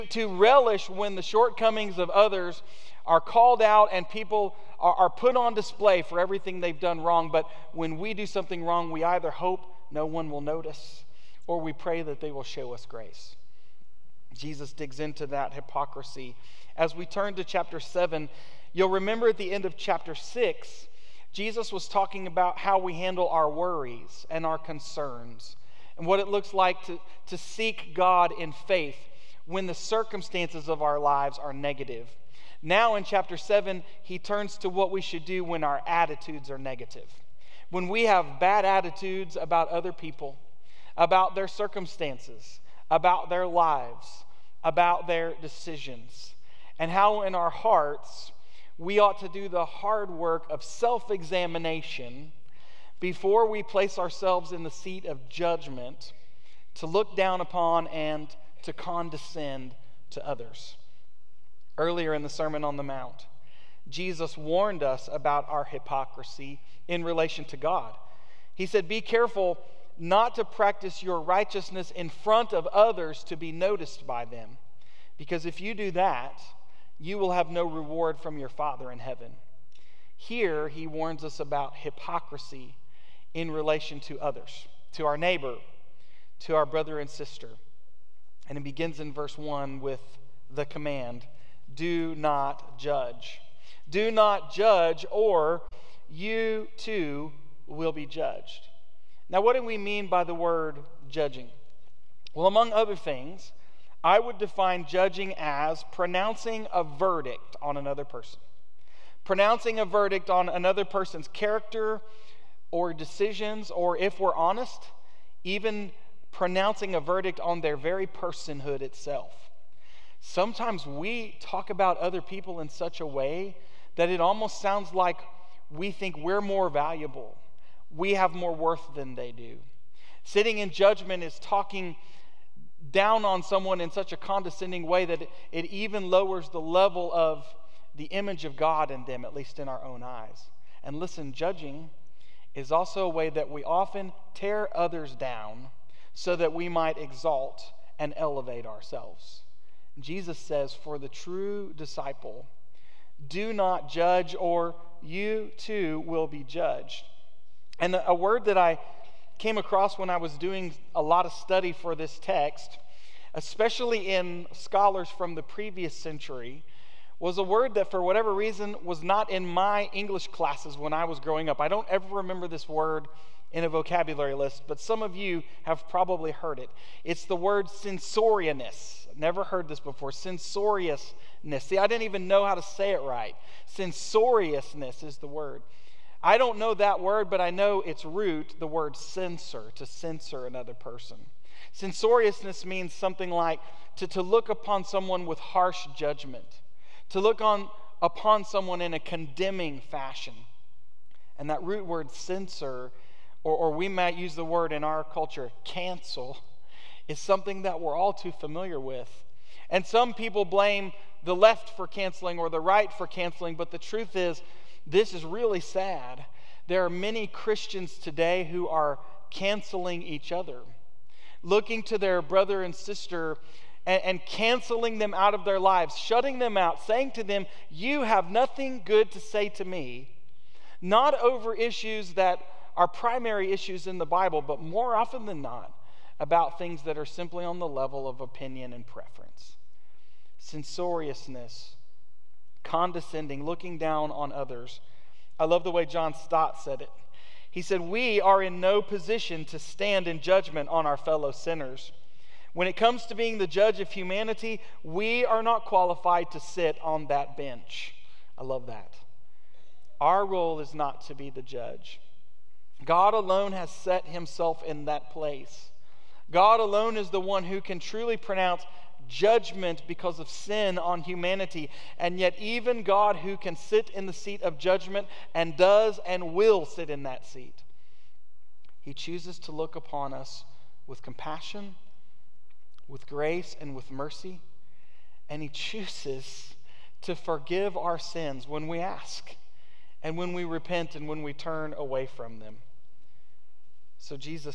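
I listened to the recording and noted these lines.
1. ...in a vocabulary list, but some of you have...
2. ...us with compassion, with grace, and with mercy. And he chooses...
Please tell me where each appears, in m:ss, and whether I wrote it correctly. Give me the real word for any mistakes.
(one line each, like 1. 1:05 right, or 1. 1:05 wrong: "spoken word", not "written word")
1. 2:53 right
2. 4:40 right.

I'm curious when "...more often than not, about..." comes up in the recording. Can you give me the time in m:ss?
3:54.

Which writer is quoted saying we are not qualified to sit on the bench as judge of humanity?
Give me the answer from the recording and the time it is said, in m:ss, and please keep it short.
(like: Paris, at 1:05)
John Stott, at 4:05.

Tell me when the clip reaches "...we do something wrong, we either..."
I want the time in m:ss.
0:07.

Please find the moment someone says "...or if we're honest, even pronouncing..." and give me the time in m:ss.
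1:53.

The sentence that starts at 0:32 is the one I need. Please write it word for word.
Now in chapter 7, he turns to what we should do when our attitudes are negative.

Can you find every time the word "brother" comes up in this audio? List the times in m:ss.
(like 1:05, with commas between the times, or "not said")
1:26, 3:42.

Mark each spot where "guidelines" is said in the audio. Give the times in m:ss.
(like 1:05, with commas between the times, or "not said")
not said.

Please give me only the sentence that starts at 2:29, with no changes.
Jesus says, For the true disciple, do not judge, or you too will be judged.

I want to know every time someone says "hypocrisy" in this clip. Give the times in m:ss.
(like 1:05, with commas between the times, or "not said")
0:15, 1:05, 1:21.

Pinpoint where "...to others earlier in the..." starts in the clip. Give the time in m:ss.
1:00.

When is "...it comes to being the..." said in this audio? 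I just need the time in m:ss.
4:12.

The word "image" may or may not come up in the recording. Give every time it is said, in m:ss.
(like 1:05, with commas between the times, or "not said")
2:18.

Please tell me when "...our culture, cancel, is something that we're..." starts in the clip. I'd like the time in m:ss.
3:24.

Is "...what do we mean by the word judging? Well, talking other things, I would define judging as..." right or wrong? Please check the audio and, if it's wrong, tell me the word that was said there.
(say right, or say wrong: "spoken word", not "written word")
wrong: "among", not "talking".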